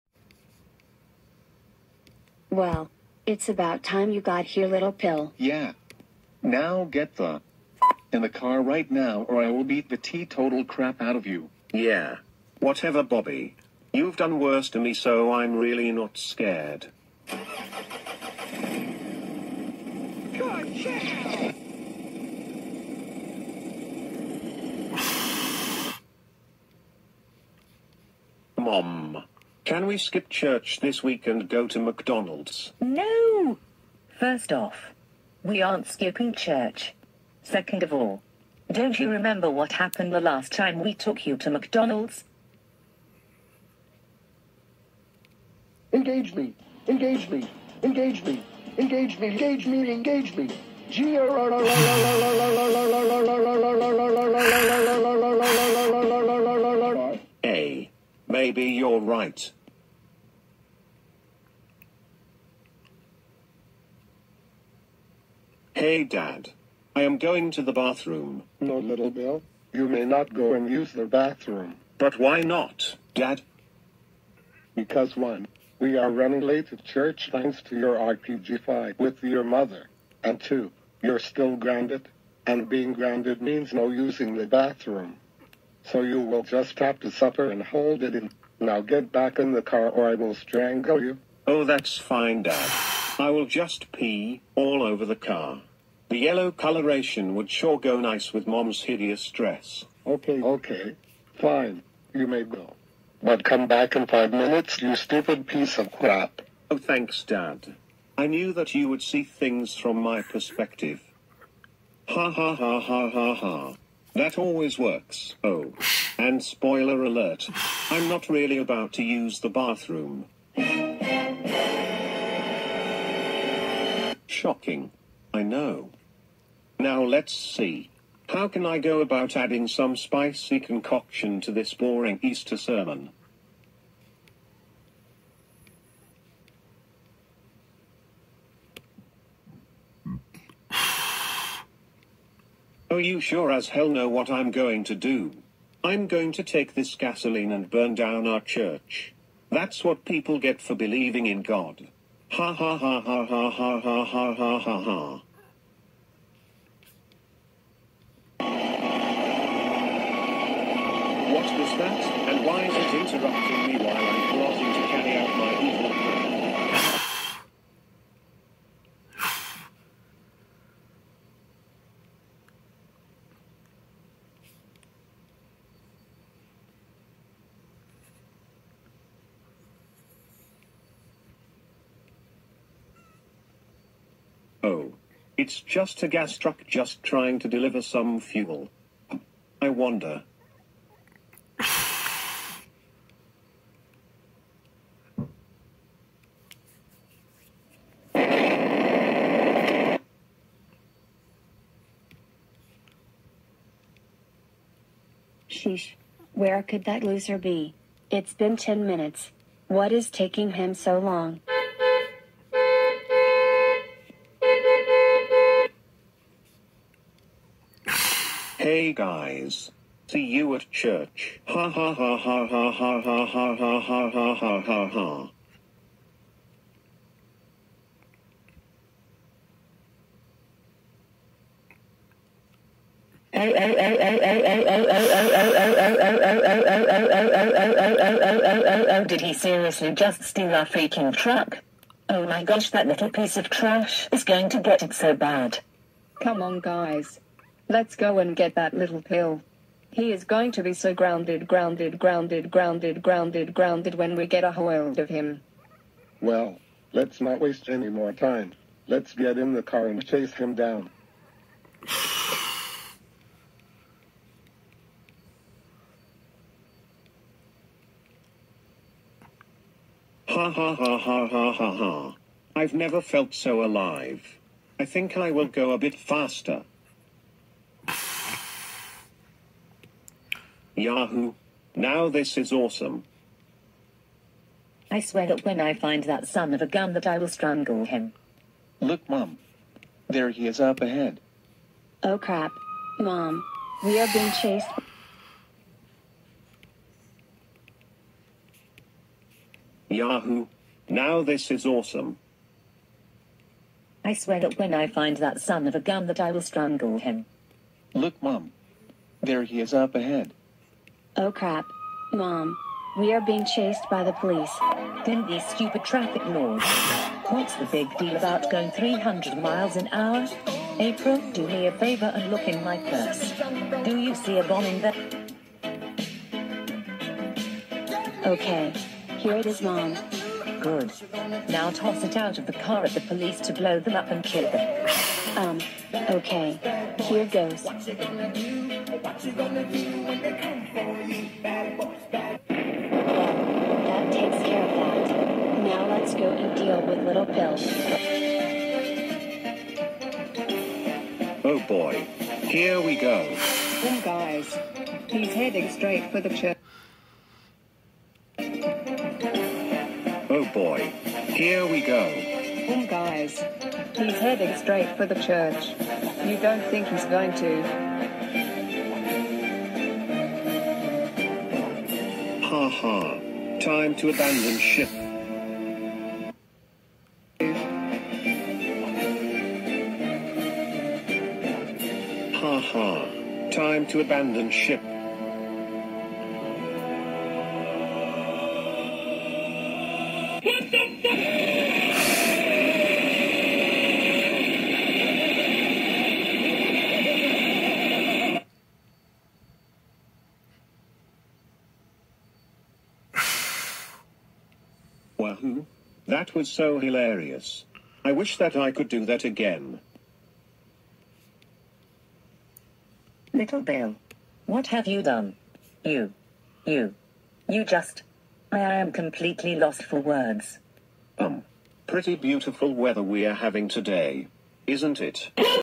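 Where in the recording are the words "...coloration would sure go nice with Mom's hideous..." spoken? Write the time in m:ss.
1:36.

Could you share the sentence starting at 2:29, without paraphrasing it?
That's what people get for believing in God.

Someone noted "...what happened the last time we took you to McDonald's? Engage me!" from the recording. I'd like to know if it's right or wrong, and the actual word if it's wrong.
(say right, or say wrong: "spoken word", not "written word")
right.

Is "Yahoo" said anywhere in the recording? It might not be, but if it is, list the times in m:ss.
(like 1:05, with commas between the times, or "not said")
4:40, 4:59.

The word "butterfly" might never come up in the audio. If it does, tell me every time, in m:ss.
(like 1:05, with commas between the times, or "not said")
not said.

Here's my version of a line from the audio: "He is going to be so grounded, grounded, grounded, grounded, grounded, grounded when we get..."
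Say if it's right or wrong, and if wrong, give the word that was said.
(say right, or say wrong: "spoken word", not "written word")
right.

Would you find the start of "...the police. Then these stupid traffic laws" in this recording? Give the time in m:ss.
5:14.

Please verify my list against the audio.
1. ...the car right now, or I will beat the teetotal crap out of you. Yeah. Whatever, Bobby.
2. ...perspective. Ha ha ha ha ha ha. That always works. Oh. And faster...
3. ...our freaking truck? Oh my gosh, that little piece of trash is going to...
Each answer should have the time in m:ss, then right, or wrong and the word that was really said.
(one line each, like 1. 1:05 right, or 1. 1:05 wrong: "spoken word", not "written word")
1. 0:08 right
2. 1:50 wrong: "spoiler", not "faster"
3. 4:00 right.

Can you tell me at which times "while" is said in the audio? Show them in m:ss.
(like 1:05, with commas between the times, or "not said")
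2:43.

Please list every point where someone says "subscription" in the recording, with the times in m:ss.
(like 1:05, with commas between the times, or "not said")
not said.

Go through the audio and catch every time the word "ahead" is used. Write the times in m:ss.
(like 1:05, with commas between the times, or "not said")
4:50, 5:09.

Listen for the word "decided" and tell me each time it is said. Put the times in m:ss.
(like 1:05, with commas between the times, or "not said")
not said.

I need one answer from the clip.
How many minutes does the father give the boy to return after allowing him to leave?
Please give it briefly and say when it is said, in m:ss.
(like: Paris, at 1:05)
5, at 1:44.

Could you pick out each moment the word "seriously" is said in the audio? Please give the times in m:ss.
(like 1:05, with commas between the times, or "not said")
3:59.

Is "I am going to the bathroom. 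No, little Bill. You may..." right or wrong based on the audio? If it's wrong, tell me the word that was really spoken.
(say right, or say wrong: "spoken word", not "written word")
right.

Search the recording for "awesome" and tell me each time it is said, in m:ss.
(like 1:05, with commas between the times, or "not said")
4:42, 5:01.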